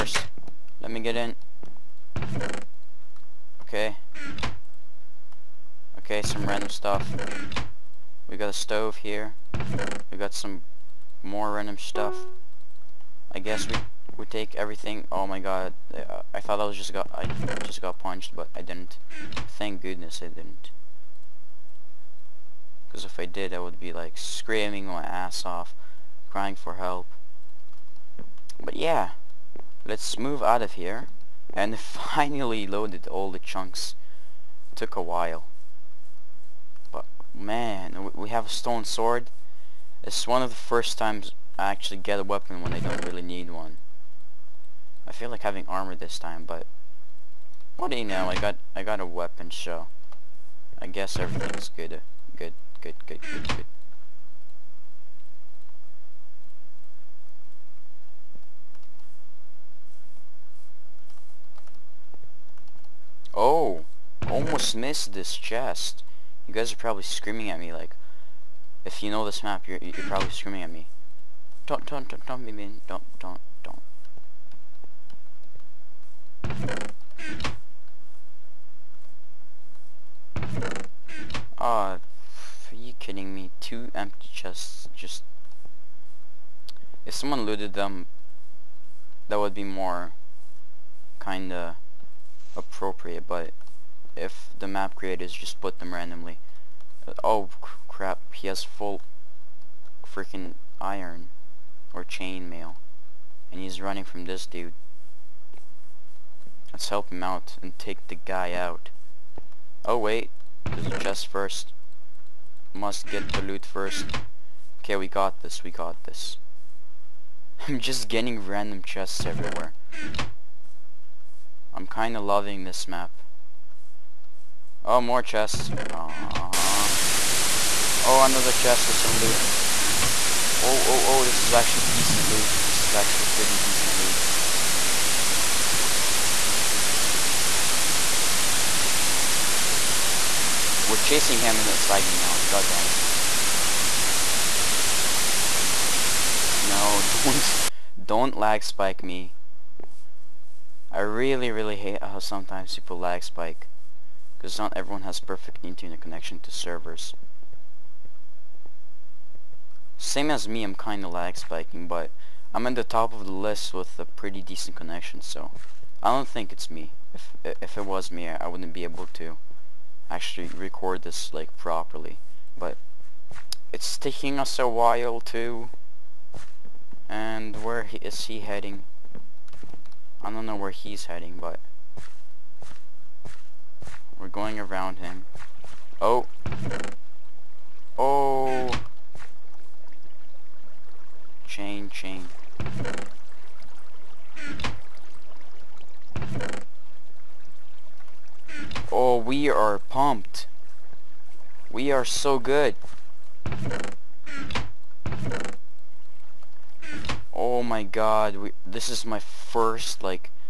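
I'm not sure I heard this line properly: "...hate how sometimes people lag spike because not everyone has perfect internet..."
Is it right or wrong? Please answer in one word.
right.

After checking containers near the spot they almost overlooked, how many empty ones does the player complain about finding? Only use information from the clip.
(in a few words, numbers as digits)
2.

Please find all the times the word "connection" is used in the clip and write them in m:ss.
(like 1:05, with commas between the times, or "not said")
2:35, 2:44.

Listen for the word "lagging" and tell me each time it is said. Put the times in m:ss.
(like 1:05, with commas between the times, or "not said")
2:21.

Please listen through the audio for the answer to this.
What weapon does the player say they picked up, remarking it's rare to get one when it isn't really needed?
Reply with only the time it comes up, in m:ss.
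0:38.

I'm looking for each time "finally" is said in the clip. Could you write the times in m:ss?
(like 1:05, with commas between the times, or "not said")
0:31.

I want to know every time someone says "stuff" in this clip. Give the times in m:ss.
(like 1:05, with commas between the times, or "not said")
0:06, 0:11.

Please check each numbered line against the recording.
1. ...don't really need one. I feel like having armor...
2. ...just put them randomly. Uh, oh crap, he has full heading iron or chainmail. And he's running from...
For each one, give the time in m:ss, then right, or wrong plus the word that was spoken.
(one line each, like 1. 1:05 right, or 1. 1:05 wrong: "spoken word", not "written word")
1. 0:42 right
2. 1:35 wrong: "freaking", not "heading".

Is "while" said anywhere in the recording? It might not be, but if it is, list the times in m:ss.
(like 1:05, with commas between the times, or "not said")
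0:35, 2:54.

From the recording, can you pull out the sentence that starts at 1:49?
Oh wait, there's a chest first.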